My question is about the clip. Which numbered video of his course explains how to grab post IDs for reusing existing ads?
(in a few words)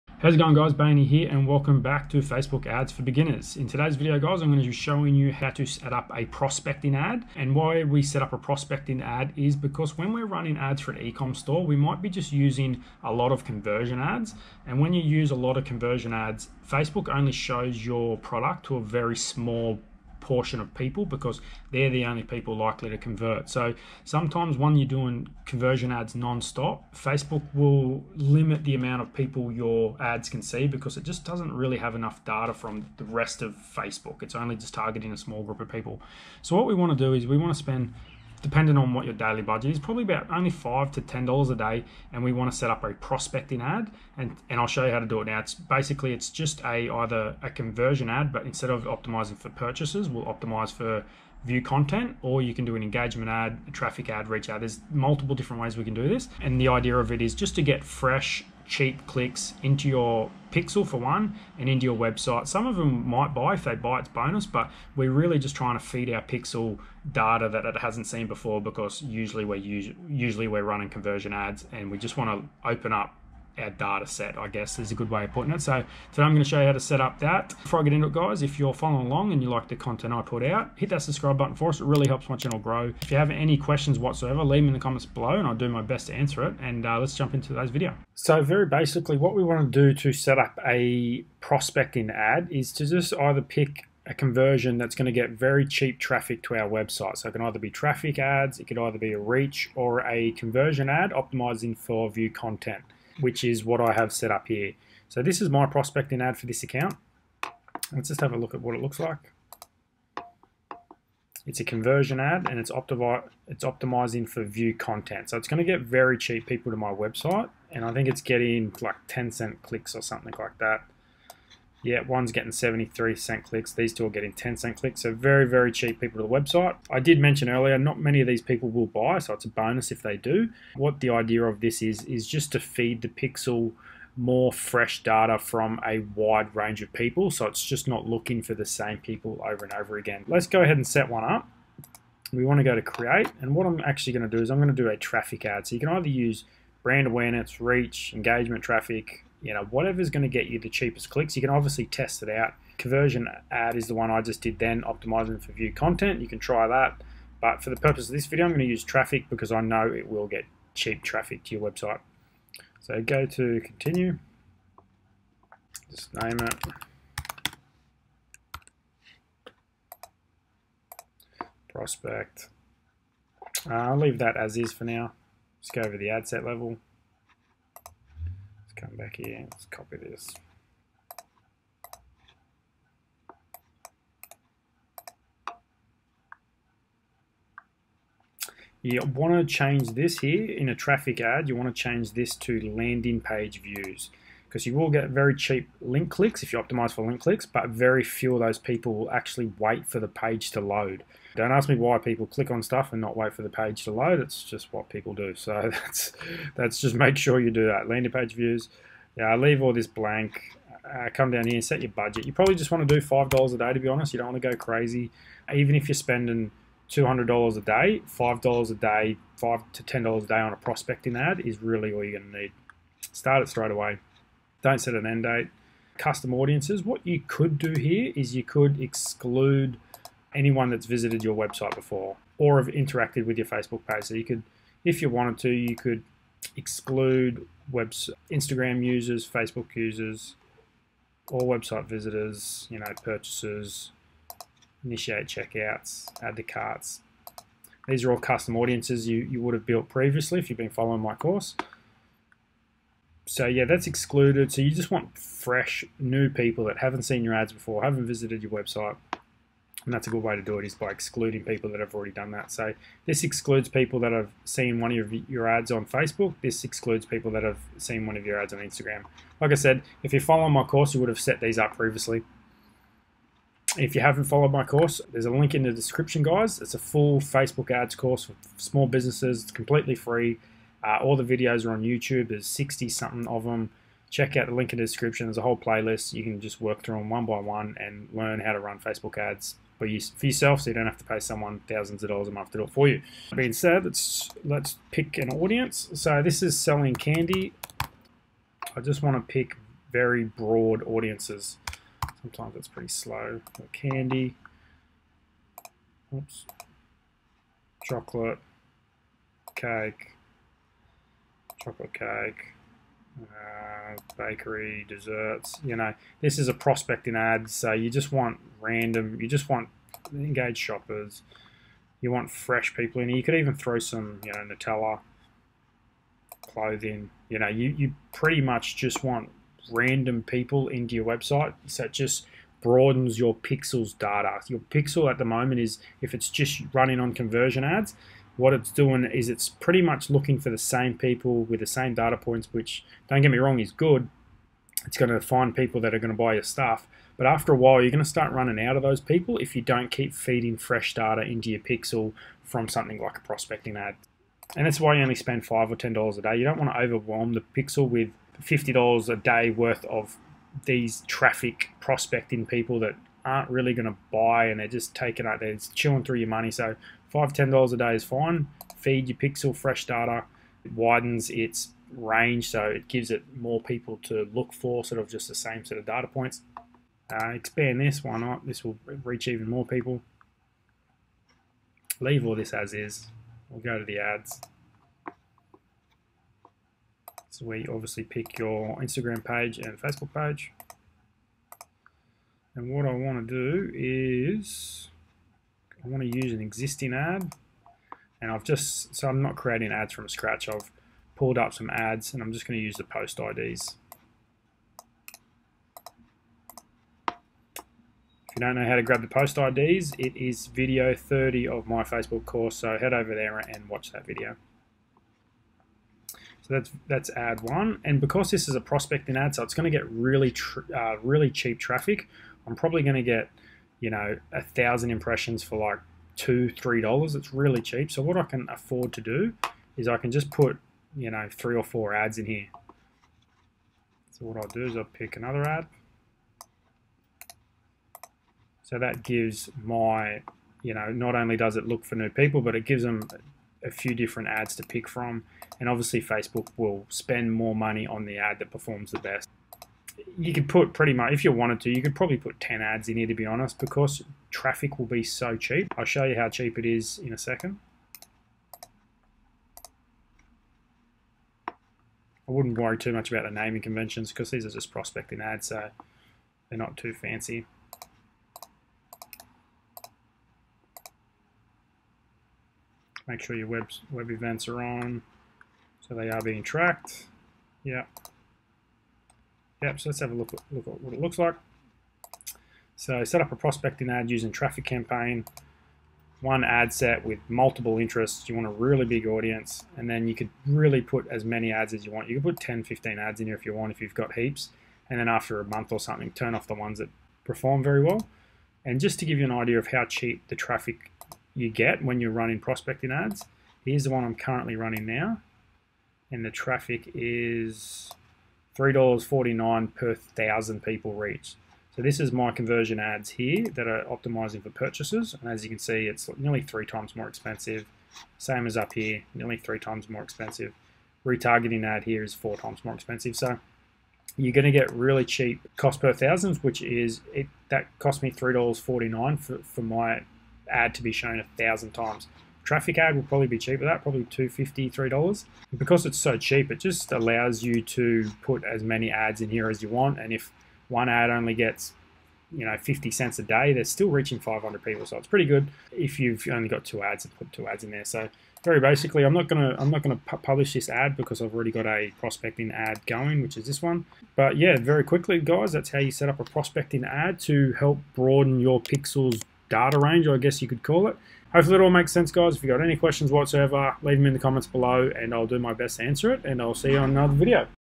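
Video 30.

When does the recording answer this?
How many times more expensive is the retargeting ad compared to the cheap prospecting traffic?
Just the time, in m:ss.
8:42.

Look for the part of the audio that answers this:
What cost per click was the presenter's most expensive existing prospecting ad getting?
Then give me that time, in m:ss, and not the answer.
2:02.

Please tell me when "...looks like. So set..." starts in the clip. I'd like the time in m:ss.
8:00.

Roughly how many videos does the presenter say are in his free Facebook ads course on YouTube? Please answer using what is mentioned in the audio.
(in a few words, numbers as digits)
60 something.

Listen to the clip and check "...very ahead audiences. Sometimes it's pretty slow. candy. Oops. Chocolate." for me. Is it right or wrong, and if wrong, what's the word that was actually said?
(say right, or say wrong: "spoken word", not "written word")
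wrong: "broad", not "ahead".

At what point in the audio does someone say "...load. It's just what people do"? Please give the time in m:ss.
3:23.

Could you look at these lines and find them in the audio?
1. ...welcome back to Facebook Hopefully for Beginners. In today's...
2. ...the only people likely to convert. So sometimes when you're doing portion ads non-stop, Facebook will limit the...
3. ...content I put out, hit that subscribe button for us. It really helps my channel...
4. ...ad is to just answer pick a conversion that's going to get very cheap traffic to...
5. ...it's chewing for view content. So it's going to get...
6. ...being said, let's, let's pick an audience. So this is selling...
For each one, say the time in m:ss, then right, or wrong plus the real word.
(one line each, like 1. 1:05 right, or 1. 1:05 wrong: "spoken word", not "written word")
1. 0:01 wrong: "Ads", not "Hopefully"
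2. 0:21 wrong: "conversion", not "portion"
3. 1:19 right
4. 1:32 wrong: "either", not "answer"
5. 1:53 wrong: "optimizing", not "chewing"
6. 4:53 right.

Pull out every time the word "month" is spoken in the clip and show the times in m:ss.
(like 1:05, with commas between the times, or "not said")
4:52, 8:15.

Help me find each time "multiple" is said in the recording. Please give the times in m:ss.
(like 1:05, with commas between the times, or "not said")
0:54, 8:07.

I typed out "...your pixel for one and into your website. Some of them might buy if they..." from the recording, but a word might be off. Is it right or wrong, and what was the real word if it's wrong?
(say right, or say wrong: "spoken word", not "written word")
right.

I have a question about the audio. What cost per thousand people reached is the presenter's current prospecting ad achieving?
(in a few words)
$3.49.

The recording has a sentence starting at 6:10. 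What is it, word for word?
It widens its range, so it gives it more people to look for, sort of just the same set of data points.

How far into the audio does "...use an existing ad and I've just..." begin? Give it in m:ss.
6:36.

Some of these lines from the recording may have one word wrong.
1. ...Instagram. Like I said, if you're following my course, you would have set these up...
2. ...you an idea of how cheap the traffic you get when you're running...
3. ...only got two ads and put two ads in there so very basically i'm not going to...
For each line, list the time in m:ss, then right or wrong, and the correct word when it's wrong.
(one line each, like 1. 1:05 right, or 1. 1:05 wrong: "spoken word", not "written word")
1. 4:28 right
2. 8:19 right
3. 9:06 right.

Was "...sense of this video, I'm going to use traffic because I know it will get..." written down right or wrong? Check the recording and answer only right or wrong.
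wrong.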